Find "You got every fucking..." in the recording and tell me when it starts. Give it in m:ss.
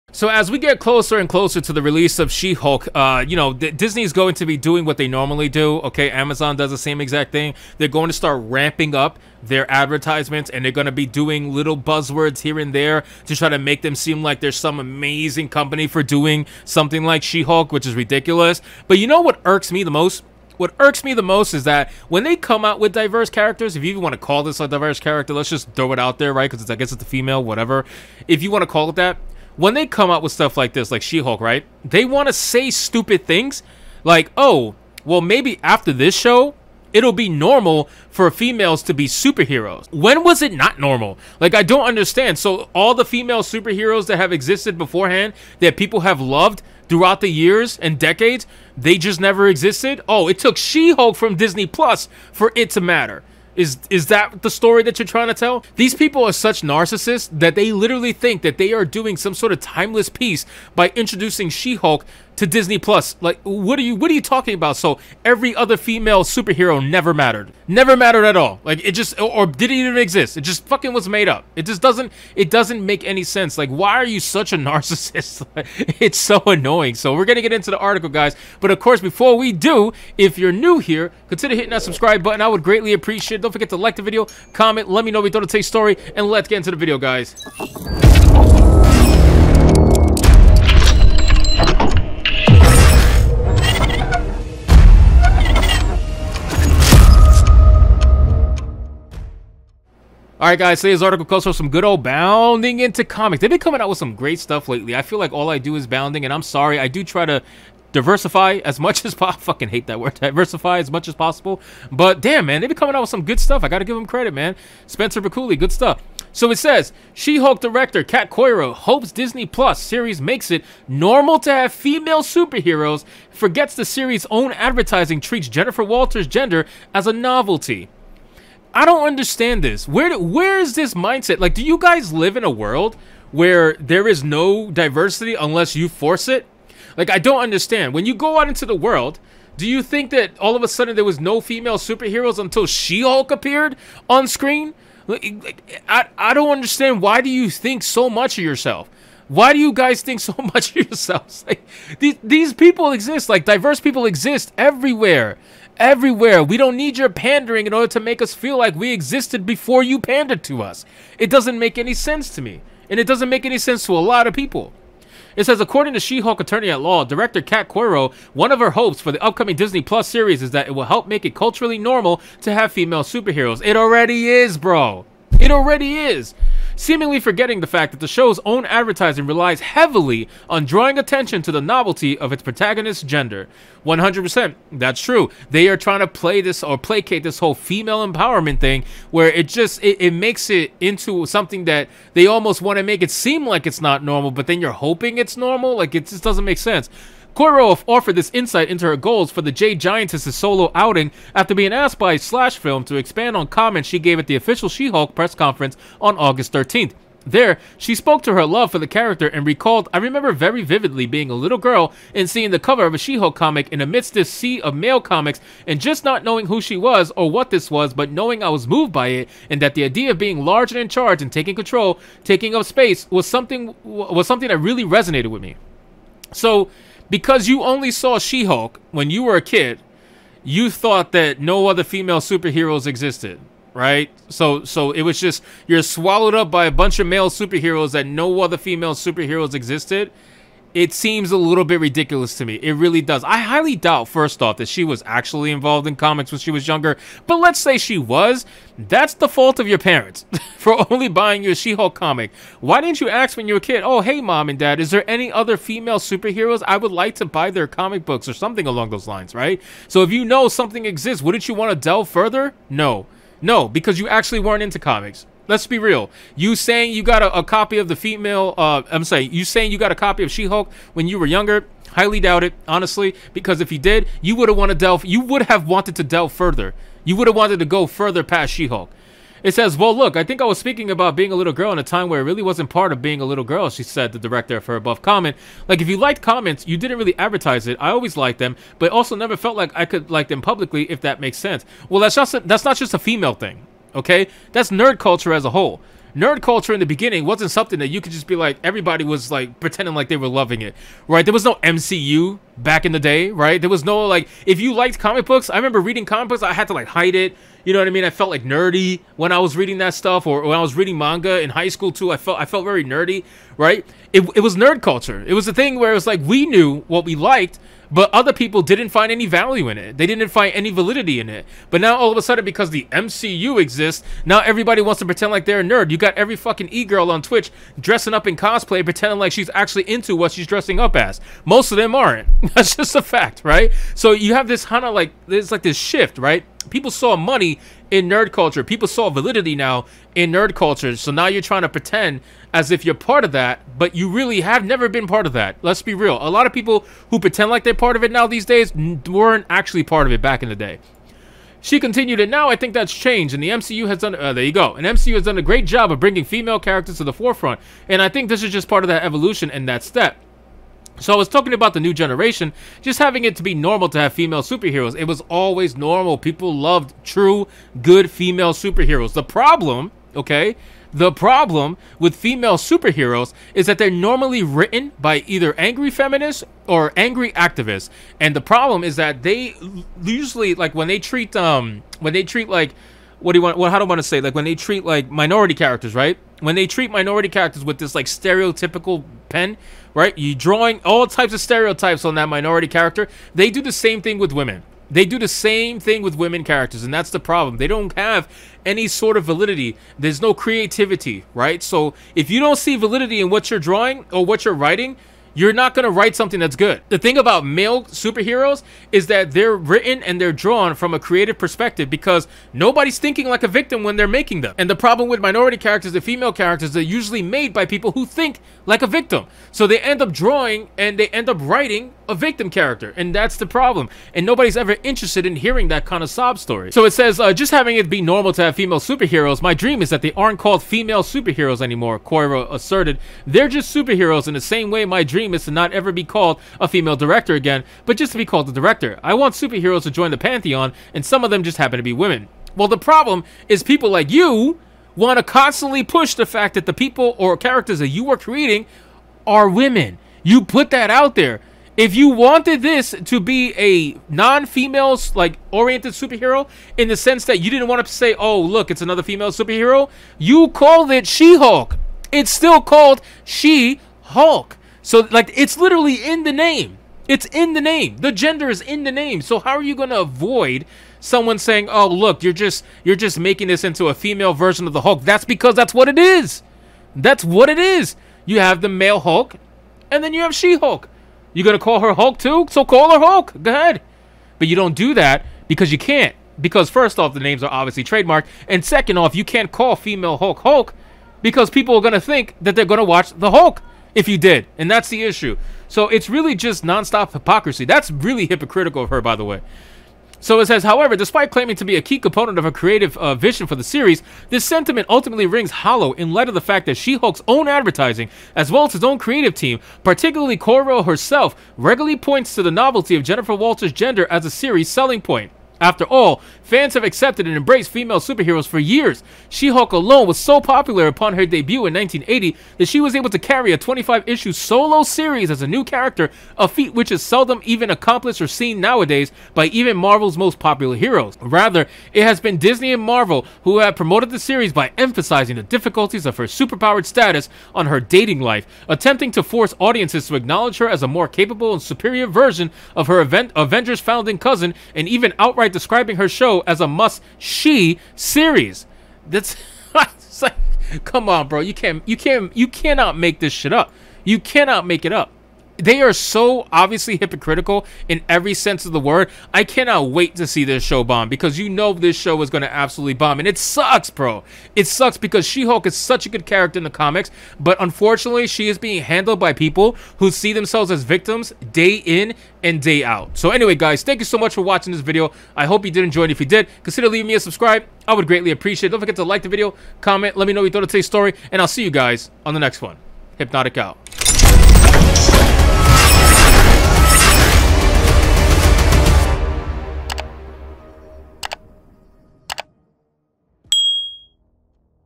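5:25.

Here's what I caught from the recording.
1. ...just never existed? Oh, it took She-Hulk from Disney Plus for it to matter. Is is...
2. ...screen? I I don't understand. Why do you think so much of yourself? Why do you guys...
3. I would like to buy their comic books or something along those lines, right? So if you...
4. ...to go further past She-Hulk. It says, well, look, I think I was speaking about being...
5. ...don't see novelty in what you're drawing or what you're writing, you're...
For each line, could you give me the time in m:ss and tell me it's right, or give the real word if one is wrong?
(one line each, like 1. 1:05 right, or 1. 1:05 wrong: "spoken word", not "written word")
1. 0:48 right
2. 2:24 right
3. 4:16 right
4. 4:37 right
5. 6:42 wrong: "validity", not "novelty".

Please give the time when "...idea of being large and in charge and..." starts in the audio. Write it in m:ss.
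3:39.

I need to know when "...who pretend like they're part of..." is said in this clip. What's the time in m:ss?
5:47.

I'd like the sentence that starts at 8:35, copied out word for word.
After all, fans have accepted and embraced female superheroes for years.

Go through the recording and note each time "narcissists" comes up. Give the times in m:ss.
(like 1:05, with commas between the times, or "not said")
0:56, 1:14.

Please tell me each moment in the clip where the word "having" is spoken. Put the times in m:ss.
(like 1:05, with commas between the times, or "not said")
6:02, 7:07.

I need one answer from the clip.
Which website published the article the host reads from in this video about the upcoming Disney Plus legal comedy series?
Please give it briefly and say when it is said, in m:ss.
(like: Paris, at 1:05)
Bounding Into Comics, at 1:42.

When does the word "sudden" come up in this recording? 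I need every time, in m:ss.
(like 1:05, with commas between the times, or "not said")
2:20, 5:22.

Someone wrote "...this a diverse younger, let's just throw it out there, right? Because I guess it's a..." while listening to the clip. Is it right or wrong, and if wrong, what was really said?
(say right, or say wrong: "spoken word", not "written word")
wrong: "character", not "younger".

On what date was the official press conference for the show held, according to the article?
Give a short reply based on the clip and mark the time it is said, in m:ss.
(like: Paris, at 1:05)
August 13, at 3:26.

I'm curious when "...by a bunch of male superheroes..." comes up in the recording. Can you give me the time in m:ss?
3:56.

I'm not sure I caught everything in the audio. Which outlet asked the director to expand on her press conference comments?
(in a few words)
Slash Film.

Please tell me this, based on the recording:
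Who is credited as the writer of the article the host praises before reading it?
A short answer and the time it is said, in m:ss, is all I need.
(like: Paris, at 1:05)
Spencer Baculi, at 1:54.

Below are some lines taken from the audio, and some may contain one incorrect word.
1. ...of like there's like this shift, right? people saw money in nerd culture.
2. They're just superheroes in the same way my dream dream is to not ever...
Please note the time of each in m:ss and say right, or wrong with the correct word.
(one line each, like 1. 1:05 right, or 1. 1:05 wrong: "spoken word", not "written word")
1. 5:34 right
2. 7:13 right.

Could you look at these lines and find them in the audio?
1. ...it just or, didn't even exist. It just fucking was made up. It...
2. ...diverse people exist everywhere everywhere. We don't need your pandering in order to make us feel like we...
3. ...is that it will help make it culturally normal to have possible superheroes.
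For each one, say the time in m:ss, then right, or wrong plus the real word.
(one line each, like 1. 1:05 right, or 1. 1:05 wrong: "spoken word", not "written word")
1. 1:08 right
2. 2:33 right
3. 2:50 wrong: "female", not "possible".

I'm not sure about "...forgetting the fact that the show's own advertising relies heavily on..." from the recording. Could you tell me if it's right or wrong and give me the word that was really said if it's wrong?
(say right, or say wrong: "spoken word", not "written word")
right.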